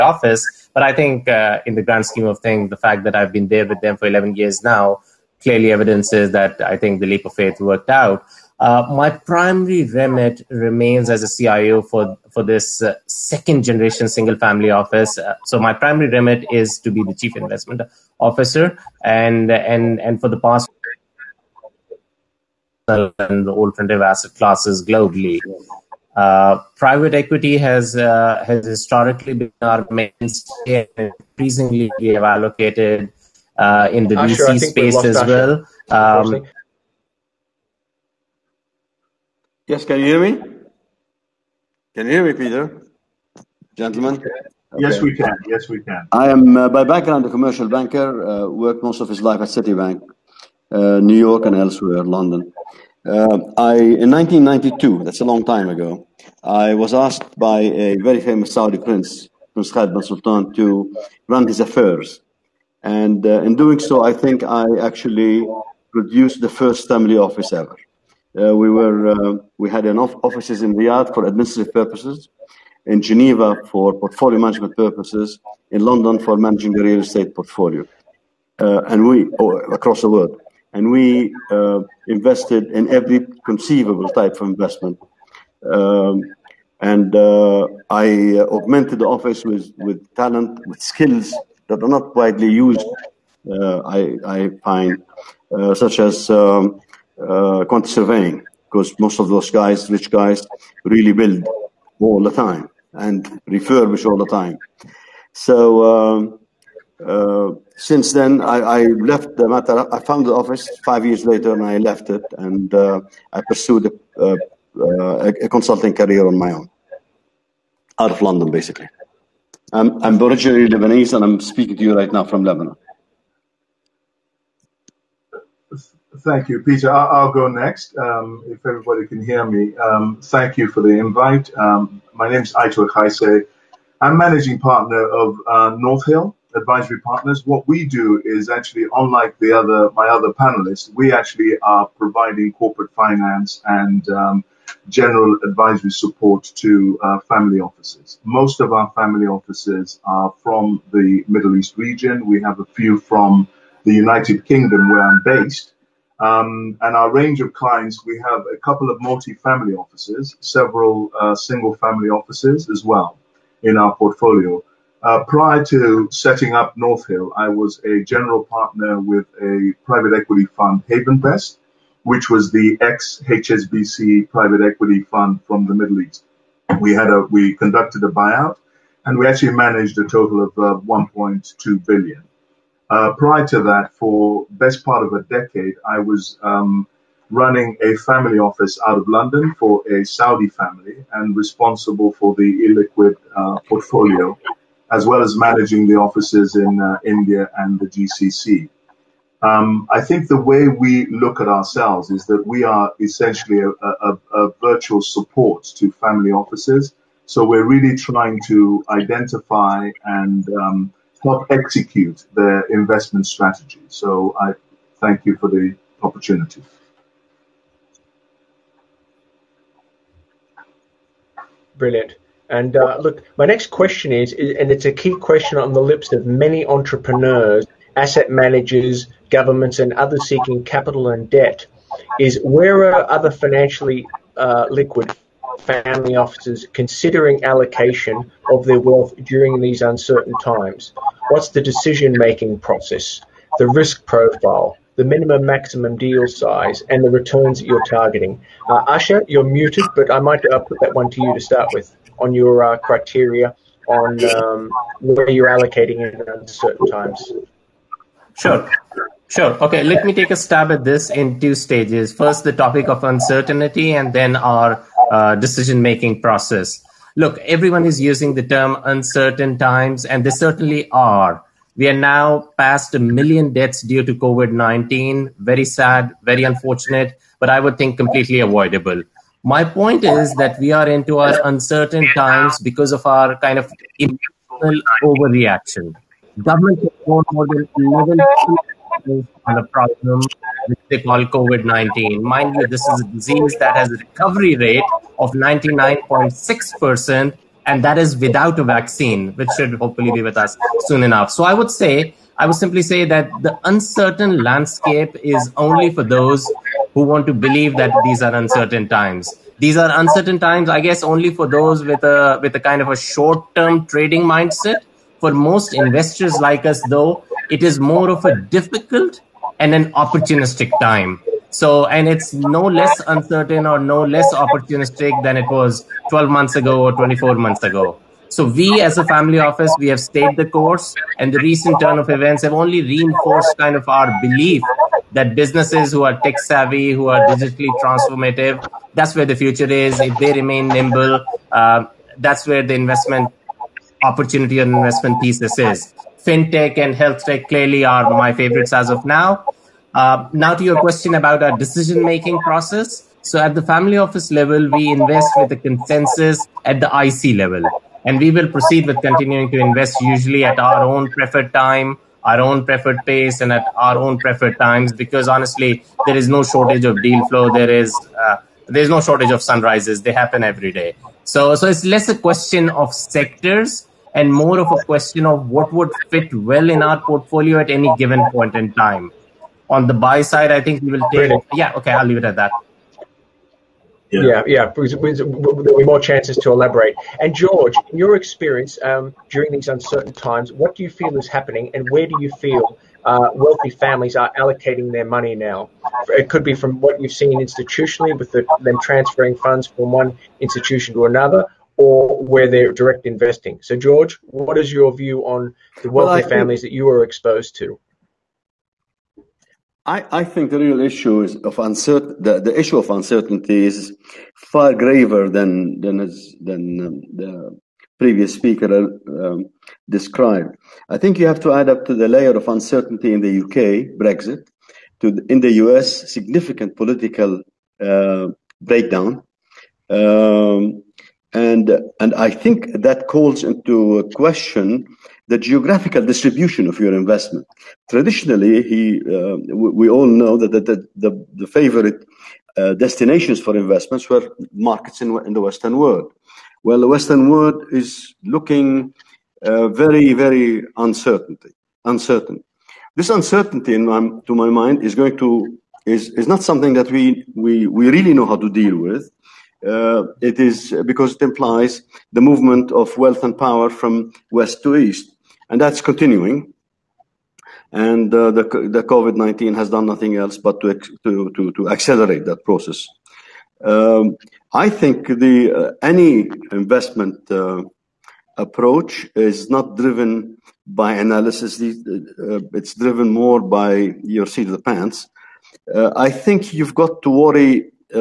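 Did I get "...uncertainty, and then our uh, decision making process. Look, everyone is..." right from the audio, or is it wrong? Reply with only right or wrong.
right.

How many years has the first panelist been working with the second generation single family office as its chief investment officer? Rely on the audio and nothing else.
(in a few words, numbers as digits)
11.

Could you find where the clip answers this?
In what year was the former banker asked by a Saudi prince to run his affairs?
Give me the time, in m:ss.
0:54.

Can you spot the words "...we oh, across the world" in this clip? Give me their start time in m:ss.
1:19.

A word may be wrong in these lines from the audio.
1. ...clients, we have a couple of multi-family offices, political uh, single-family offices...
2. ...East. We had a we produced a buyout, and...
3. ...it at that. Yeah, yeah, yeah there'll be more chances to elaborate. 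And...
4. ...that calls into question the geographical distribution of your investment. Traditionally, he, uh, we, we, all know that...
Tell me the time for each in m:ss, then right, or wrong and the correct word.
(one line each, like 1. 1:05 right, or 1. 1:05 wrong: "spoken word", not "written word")
1. 2:37 wrong: "several", not "political"
2. 2:56 wrong: "conducted", not "produced"
3. 6:22 right
4. 7:12 right.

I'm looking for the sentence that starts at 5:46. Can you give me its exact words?
FinTech and health tech clearly are my favorites as of now.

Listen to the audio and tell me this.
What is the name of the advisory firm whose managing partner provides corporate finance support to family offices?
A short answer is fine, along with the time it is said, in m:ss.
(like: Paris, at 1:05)
North Hill Advisory Partners, at 2:15.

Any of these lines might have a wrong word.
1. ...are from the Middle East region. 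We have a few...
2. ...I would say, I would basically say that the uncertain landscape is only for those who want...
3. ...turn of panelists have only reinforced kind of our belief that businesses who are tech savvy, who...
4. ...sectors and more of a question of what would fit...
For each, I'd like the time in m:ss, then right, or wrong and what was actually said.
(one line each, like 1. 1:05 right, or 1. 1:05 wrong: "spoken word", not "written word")
1. 2:30 right
2. 5:01 wrong: "simply", not "basically"
3. 5:31 wrong: "events", not "panelists"
4. 6:12 right.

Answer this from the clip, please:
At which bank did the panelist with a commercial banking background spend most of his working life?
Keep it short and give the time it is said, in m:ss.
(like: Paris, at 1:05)
Citibank, at 0:49.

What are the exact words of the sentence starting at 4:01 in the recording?
What's the decision making process, the risk profile, the minimum maximum deal size, and the returns that you're targeting?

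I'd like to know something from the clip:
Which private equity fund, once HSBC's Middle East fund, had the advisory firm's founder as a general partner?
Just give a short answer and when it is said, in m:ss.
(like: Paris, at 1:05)
Havenvest, at 2:50.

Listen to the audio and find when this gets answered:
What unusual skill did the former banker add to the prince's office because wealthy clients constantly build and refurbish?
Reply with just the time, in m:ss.
1:37.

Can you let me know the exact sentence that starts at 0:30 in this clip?
Increasingly, we have allocated uh, in the Asher, space as Asher.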